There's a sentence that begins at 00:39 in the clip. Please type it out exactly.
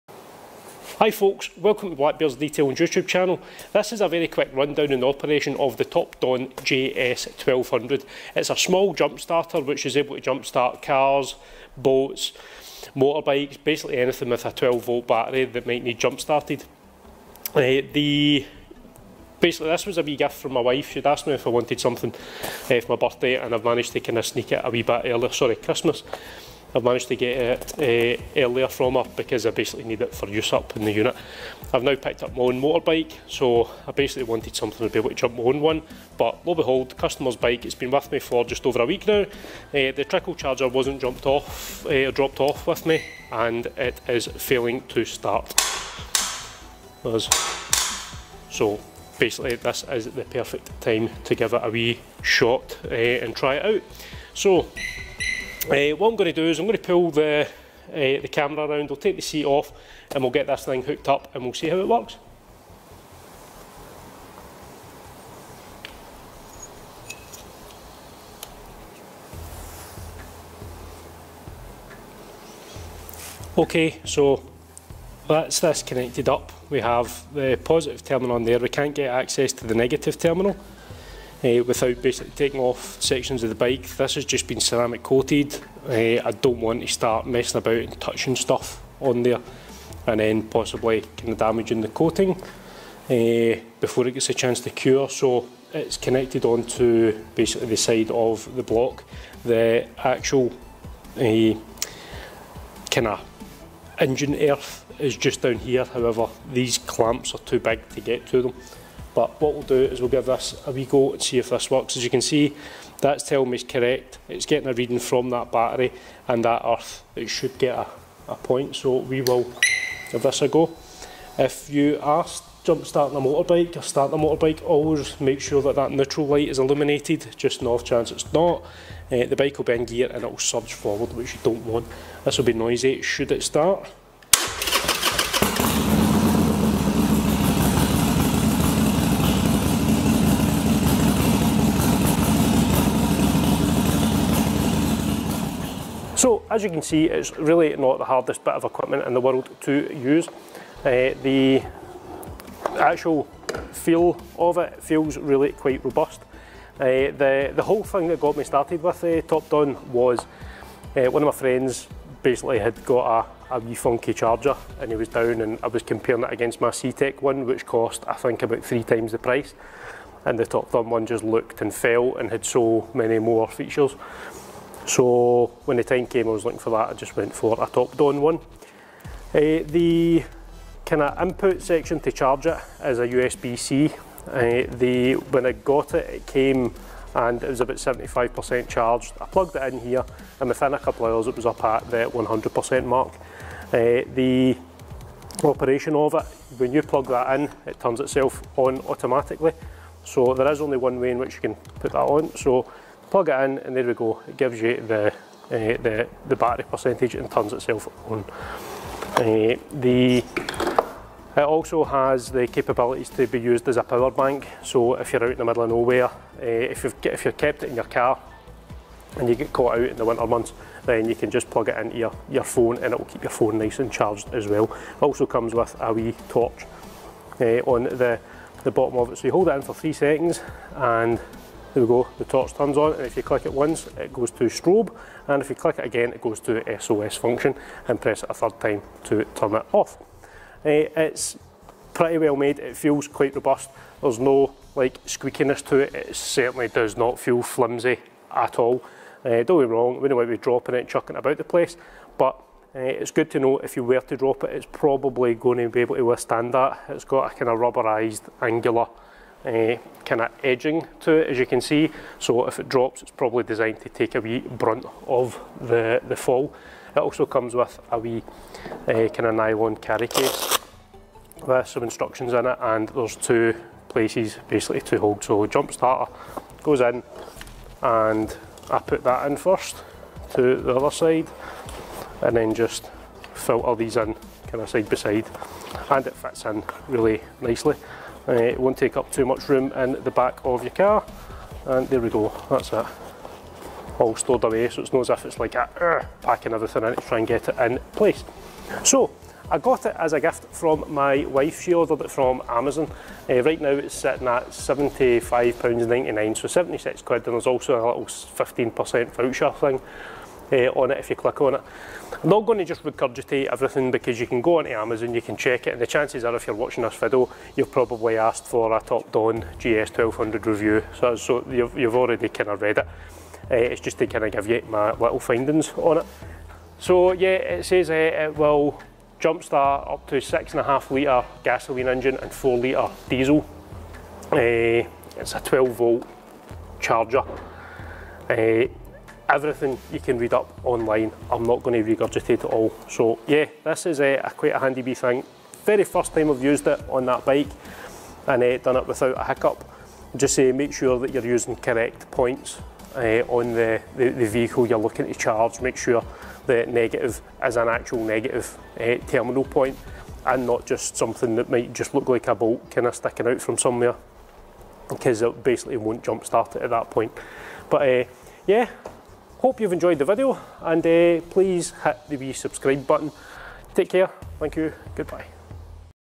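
Uh, the trickle charger wasn't jumped off, uh, dropped off with me, and it is failing to start.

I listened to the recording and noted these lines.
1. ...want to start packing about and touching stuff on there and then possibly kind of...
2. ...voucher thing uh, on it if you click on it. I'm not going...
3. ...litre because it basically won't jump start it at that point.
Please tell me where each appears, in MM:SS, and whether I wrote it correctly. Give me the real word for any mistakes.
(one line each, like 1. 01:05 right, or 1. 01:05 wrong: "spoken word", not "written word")
1. 01:26 wrong: "messing", not "packing"
2. 05:09 right
3. 06:03 wrong: "somewhere", not "litre".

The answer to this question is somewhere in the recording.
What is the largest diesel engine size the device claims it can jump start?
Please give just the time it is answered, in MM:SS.
05:32.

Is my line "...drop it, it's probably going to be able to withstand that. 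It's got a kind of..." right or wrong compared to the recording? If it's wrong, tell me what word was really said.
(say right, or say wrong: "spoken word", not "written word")
right.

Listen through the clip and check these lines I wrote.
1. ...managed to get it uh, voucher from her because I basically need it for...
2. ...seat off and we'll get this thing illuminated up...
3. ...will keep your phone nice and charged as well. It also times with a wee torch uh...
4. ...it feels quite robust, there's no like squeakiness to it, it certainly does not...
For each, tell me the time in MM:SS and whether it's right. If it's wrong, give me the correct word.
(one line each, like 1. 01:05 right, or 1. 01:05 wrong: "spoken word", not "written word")
1. 00:26 wrong: "earlier", not "voucher"
2. 00:59 wrong: "hooked", not "illuminated"
3. 03:42 wrong: "comes", not "times"
4. 04:02 right.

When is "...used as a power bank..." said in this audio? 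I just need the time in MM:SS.
03:33.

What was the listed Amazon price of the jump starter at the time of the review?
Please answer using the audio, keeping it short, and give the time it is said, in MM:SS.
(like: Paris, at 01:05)
£75.99, at 05:04.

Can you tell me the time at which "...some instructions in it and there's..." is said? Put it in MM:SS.
04:31.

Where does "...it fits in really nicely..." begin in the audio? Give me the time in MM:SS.
04:46.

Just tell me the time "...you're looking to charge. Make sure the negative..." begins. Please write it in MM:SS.
05:54.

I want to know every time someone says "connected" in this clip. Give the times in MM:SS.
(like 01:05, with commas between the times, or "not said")
01:15, 01:35.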